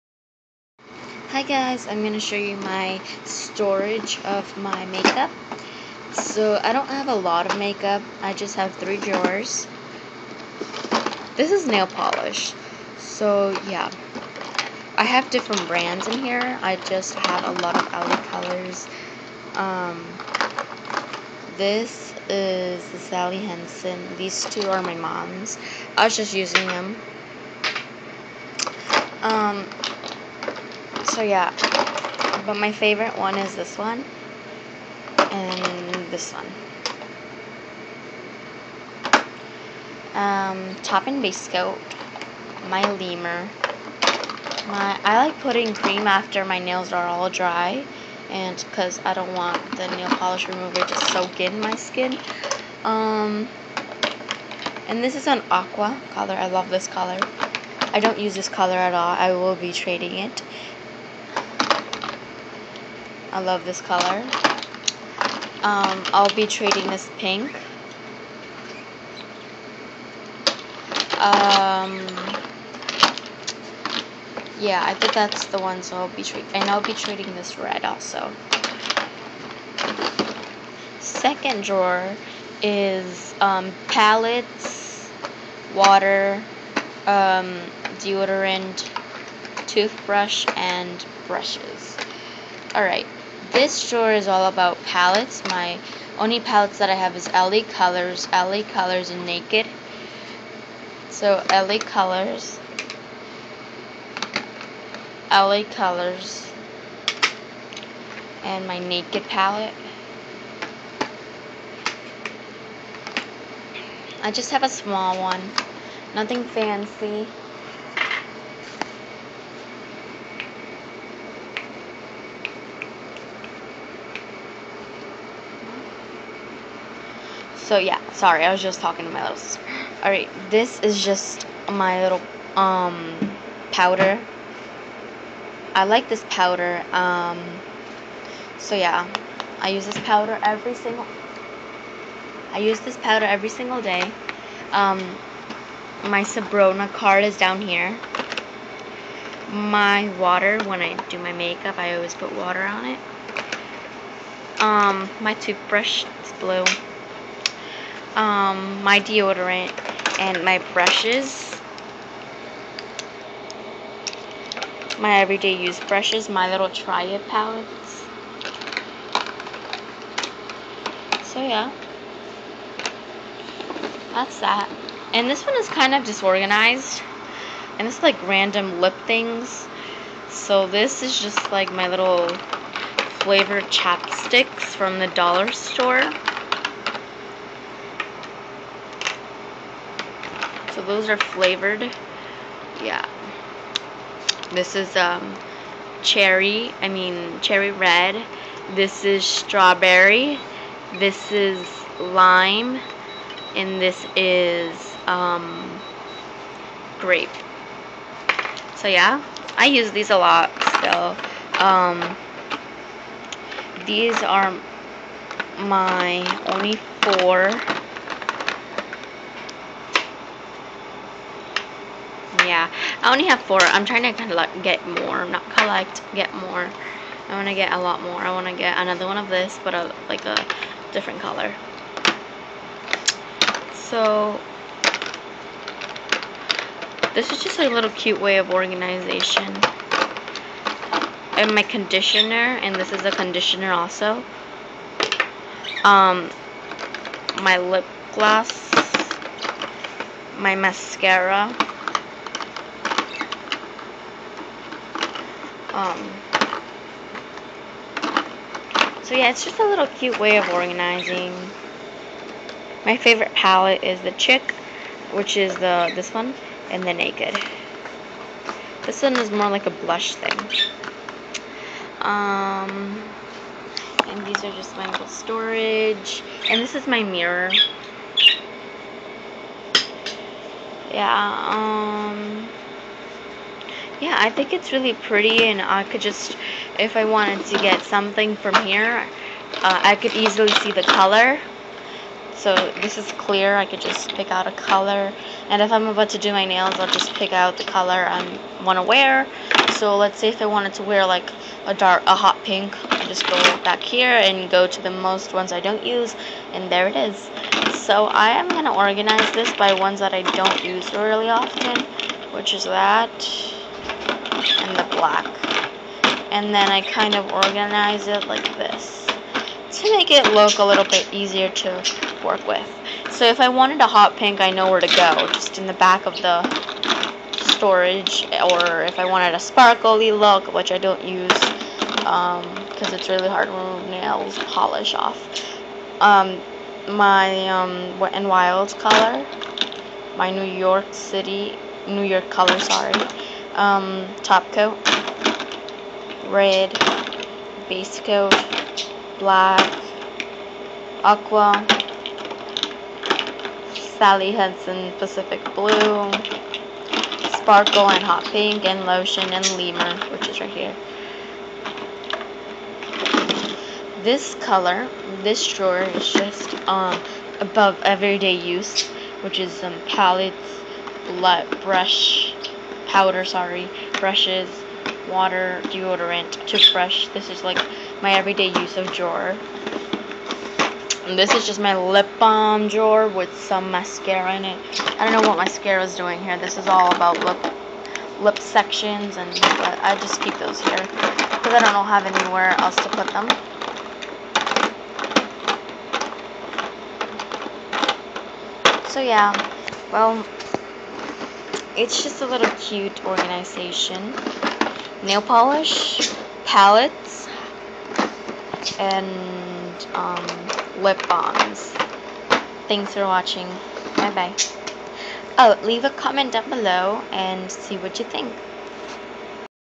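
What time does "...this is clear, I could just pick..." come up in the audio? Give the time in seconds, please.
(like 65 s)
292 s.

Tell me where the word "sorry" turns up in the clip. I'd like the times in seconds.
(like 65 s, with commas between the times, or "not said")
128 s, 342 s, 373 s.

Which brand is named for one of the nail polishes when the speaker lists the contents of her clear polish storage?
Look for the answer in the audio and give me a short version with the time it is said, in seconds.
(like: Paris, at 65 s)
Wet n Wild, at 337 s.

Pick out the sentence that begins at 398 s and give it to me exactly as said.
So yeah, well, it's just a little cute organization nail polish, palettes, and um, lip balms.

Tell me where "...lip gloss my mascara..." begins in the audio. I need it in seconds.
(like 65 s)
247 s.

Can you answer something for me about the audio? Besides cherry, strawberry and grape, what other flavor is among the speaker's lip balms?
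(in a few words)
lime.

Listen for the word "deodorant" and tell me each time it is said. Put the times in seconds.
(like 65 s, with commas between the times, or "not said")
87 s, 158 s, 375 s.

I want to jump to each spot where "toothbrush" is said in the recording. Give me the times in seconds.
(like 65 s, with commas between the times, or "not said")
89 s, 155 s, 376 s.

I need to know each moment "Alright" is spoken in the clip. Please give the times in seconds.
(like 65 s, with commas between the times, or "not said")
92 s, 130 s.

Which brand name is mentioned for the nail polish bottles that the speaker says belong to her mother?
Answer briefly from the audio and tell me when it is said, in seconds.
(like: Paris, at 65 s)
Sally Hansen, at 22 s.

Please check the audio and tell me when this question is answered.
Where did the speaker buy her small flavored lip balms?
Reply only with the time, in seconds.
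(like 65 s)
185 s.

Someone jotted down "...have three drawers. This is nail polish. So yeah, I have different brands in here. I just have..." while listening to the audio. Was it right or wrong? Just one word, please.
right.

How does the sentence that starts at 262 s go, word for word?
My favorite palette is the Chick, which is the this one, and the Naked.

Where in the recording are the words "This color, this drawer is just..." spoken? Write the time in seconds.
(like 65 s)
364 s.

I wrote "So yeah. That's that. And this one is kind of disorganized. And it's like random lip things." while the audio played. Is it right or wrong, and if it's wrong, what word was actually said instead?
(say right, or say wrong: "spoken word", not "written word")
right.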